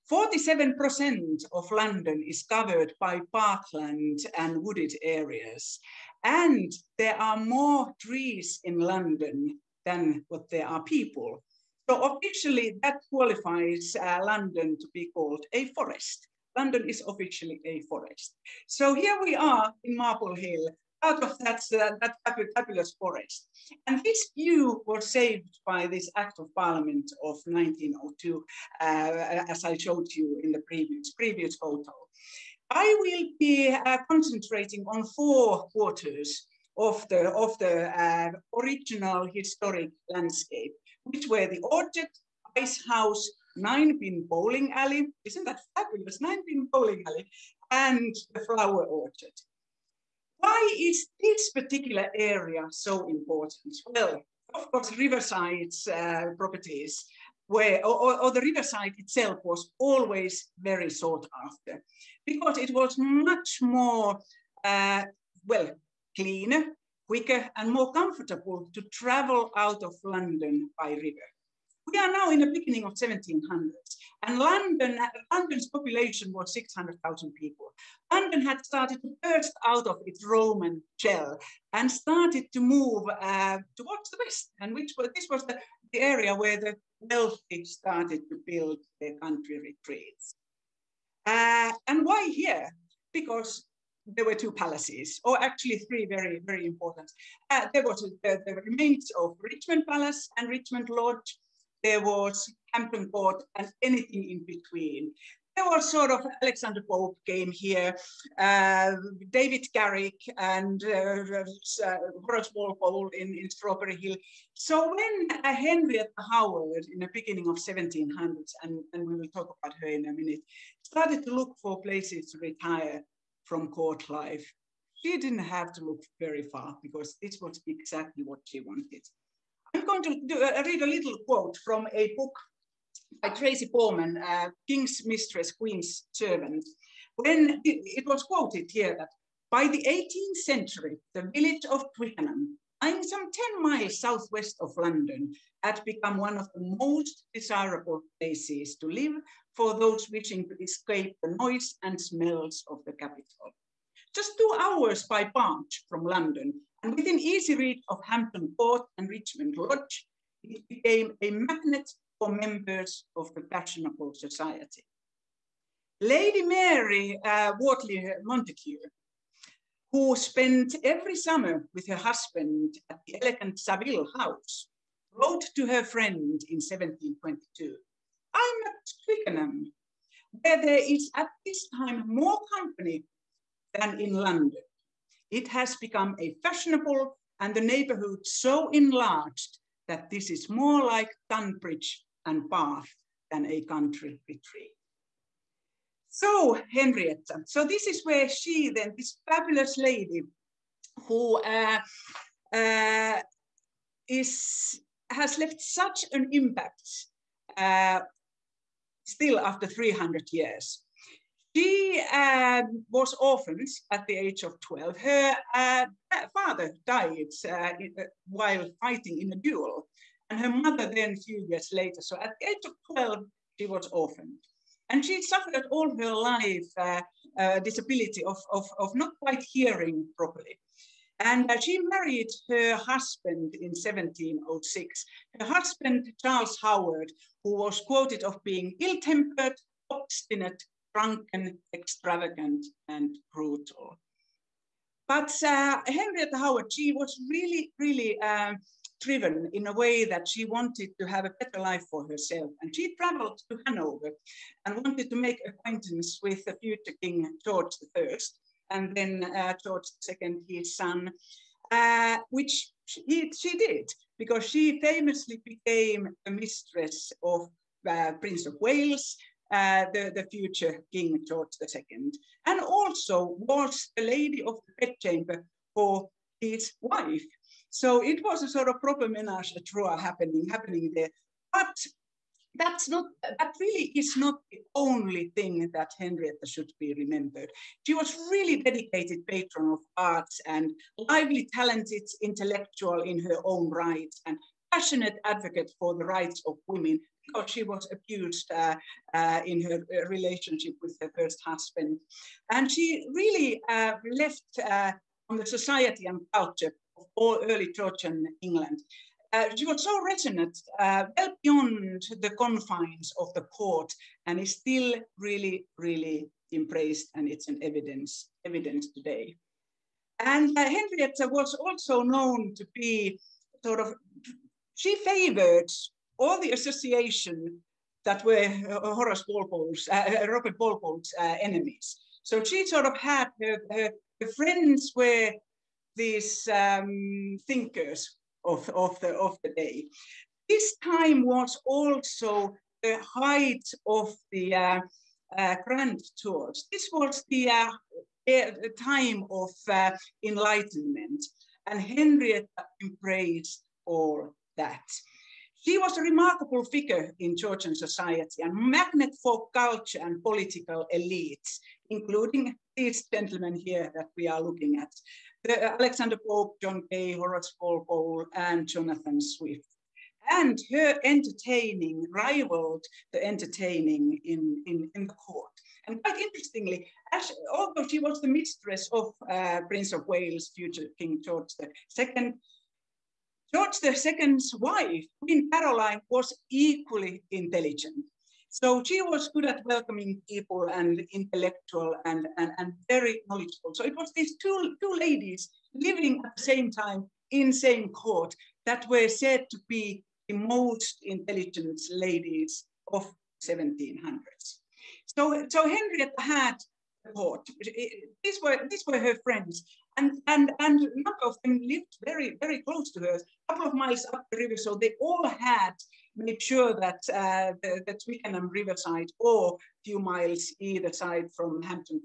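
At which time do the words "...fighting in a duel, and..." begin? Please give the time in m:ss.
3:38.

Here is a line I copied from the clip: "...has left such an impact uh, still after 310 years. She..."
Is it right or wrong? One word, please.
wrong.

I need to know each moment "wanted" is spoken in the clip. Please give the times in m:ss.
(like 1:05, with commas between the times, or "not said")
2:08, 4:10, 4:14.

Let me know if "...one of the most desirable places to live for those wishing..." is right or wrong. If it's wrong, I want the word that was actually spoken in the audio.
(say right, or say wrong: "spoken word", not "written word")
right.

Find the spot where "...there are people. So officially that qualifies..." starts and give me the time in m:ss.
0:10.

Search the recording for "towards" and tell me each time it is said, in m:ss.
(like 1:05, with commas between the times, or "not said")
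1:23.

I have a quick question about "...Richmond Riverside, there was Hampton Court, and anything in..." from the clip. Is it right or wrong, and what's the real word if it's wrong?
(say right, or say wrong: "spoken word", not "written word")
wrong: "Lodge", not "Riverside".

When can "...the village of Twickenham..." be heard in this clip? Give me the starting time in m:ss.
2:21.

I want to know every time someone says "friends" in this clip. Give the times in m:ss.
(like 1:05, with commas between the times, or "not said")
2:55, 5:34, 6:49.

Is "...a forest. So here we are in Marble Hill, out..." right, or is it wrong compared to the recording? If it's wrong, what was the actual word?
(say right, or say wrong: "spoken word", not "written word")
right.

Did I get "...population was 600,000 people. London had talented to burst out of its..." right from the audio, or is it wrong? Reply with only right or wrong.
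wrong.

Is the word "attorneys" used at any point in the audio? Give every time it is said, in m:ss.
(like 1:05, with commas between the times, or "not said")
not said.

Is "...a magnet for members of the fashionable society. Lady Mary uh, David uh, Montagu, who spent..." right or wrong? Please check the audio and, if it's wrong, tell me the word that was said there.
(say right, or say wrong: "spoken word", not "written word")
wrong: "Wortley", not "David".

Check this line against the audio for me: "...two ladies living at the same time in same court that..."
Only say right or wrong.
right.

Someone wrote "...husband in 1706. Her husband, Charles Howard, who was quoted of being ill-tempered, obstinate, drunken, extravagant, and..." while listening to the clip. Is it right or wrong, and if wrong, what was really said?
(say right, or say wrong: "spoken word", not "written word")
right.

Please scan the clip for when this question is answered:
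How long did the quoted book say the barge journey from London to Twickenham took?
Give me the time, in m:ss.
2:34.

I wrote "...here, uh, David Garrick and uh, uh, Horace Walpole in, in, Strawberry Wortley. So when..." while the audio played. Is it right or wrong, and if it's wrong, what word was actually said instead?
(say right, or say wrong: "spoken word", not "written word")
wrong: "Hill", not "Wortley".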